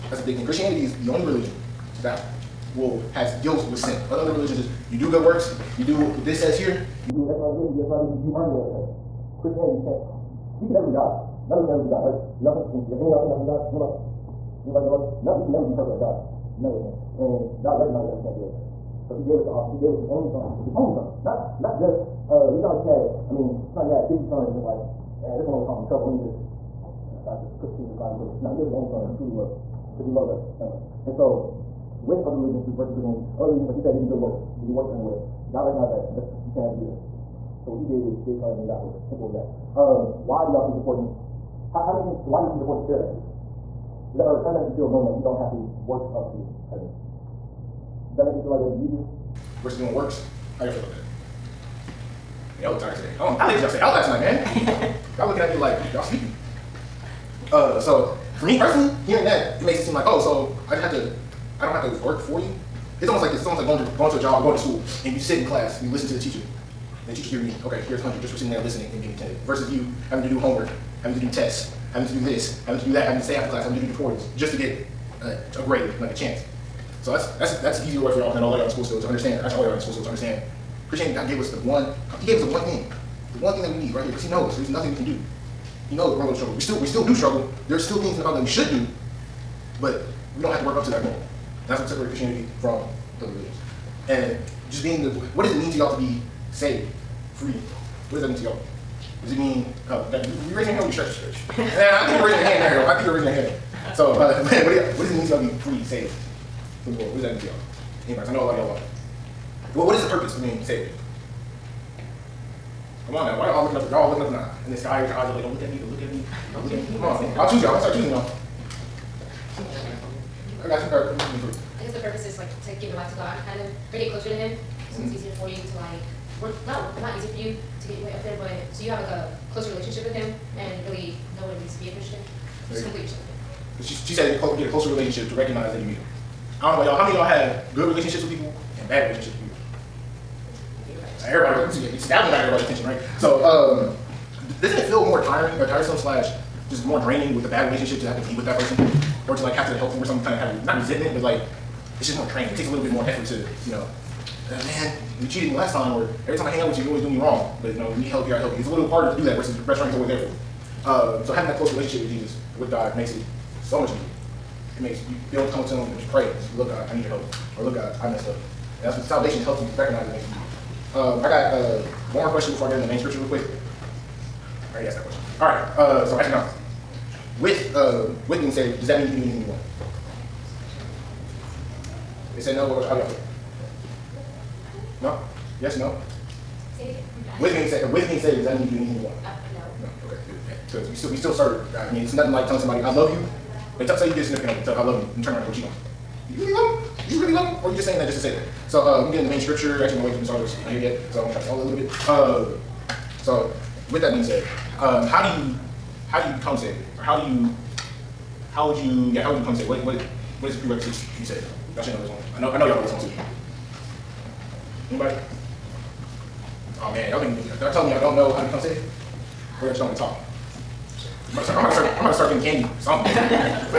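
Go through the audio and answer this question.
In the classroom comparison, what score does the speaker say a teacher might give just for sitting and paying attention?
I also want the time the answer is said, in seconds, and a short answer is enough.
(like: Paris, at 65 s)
hundred, at 68 s.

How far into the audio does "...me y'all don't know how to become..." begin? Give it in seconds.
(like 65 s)
217 s.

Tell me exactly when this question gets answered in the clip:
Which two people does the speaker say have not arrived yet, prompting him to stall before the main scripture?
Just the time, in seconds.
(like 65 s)
199 s.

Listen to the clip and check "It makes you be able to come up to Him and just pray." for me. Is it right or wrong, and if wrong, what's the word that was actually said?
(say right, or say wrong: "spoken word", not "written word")
right.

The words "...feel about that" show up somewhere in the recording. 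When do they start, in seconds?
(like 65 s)
50 s.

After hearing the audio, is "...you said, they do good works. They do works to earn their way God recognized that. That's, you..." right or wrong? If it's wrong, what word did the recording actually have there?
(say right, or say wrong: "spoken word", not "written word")
right.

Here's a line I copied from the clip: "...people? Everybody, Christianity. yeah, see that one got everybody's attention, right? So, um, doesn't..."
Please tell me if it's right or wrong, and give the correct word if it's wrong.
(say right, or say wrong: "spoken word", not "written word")
wrong: "Everybody", not "Christianity".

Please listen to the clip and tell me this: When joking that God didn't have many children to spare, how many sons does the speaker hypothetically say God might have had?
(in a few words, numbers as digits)
50.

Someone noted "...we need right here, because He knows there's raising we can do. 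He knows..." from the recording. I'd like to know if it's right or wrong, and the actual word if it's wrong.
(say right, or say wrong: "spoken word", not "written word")
wrong: "nothing", not "raising".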